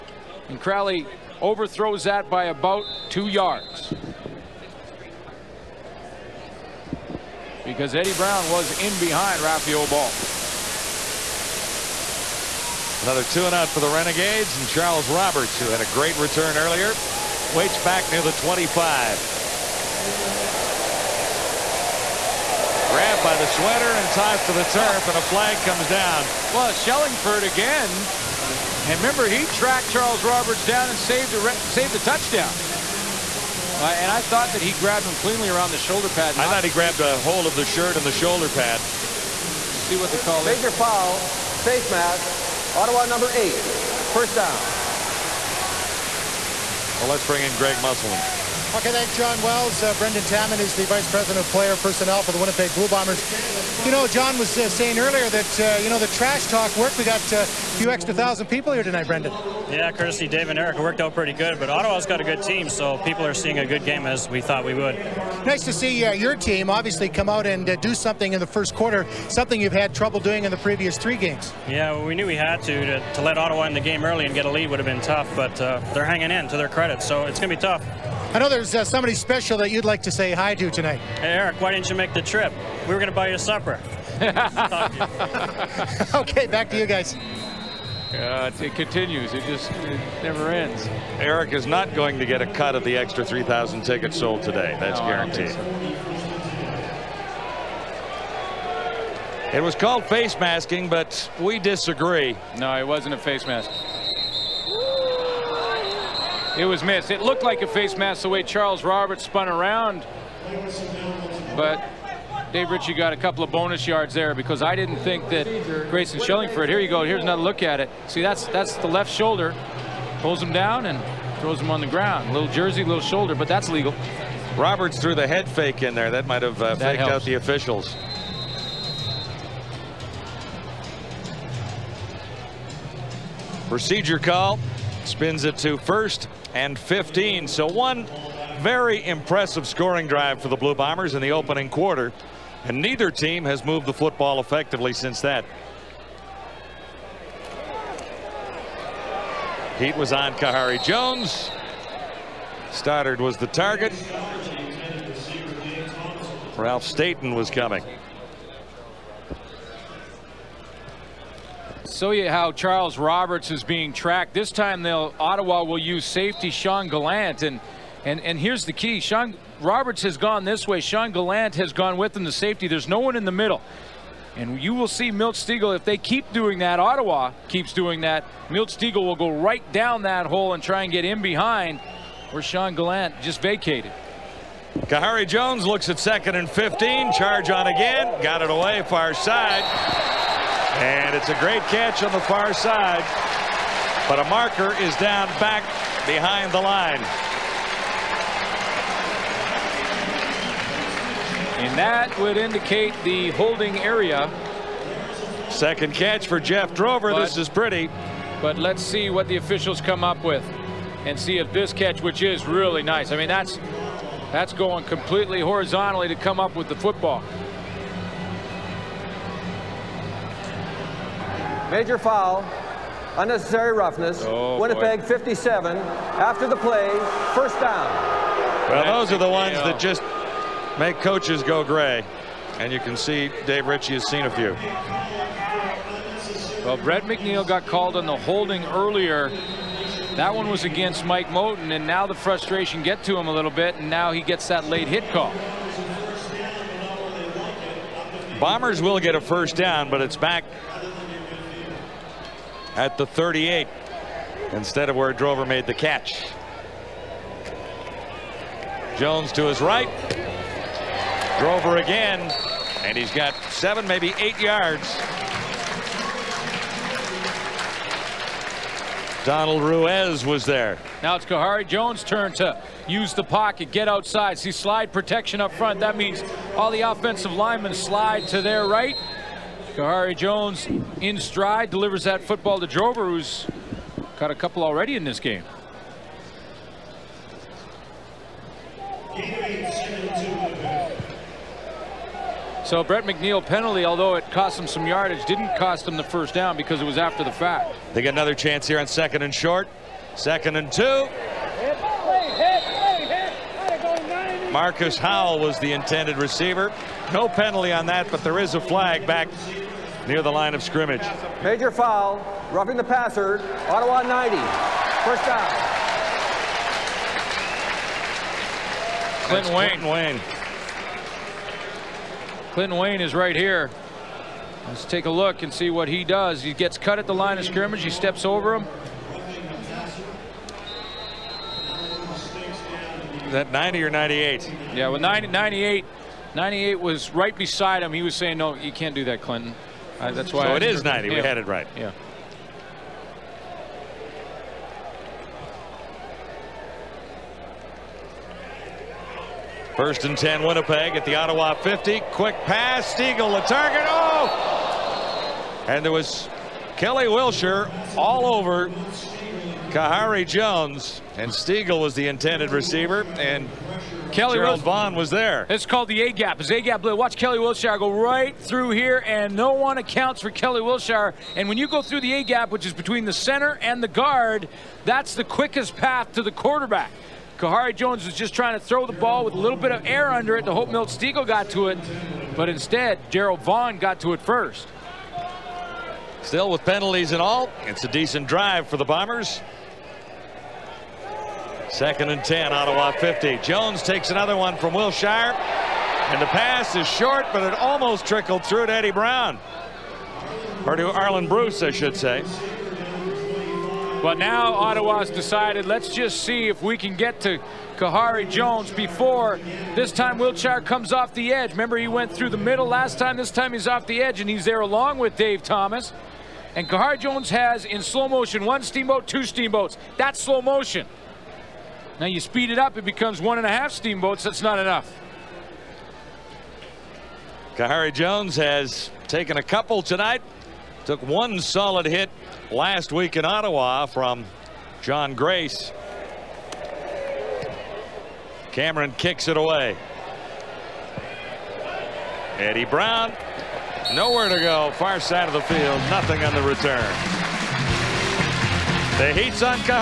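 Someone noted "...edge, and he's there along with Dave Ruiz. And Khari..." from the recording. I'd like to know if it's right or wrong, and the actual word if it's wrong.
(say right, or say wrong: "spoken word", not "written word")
wrong: "Thomas", not "Ruiz".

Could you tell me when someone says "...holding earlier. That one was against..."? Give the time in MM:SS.
03:58.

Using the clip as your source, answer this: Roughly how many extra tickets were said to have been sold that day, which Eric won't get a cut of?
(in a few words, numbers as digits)
3,000.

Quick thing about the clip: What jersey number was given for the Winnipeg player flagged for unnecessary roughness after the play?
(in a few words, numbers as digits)
57.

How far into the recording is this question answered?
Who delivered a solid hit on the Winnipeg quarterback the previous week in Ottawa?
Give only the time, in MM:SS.
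07:14.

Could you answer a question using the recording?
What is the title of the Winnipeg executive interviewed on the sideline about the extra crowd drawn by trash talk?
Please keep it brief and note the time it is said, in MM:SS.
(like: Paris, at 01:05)
Vice President of Player Personnel, at 00:50.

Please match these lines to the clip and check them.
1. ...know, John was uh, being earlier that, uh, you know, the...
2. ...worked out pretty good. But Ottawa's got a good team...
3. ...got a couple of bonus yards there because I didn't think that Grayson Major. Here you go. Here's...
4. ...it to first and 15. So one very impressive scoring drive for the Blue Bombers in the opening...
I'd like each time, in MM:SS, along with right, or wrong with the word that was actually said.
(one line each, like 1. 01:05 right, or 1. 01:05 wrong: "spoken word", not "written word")
1. 00:53 wrong: "saying", not "being"
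2. 01:00 right
3. 01:52 wrong: "Shillingford", not "Major"
4. 02:15 right.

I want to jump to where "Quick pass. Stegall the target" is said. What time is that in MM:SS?
05:52.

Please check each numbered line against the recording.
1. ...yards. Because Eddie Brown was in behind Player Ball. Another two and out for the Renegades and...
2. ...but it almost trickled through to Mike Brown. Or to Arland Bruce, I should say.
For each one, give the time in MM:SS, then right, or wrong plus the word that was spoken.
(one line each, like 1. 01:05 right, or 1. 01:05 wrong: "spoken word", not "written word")
1. 00:03 wrong: "Raphael", not "Player"
2. 06:37 wrong: "Eddie", not "Mike".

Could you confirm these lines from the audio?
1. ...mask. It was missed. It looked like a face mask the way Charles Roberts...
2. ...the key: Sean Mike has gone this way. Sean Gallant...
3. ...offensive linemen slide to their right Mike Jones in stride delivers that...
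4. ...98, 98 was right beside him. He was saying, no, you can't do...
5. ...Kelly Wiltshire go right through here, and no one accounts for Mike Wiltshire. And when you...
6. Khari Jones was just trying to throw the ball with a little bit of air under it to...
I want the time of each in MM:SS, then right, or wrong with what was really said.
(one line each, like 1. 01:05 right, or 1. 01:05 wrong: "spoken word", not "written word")
1. 01:43 right
2. 02:48 wrong: "Roberts", not "Mike"
3. 04:36 wrong: "Khari", not "Mike"
4. 05:35 right
5. 06:07 wrong: "Kelly", not "Mike"
6. 06:17 right.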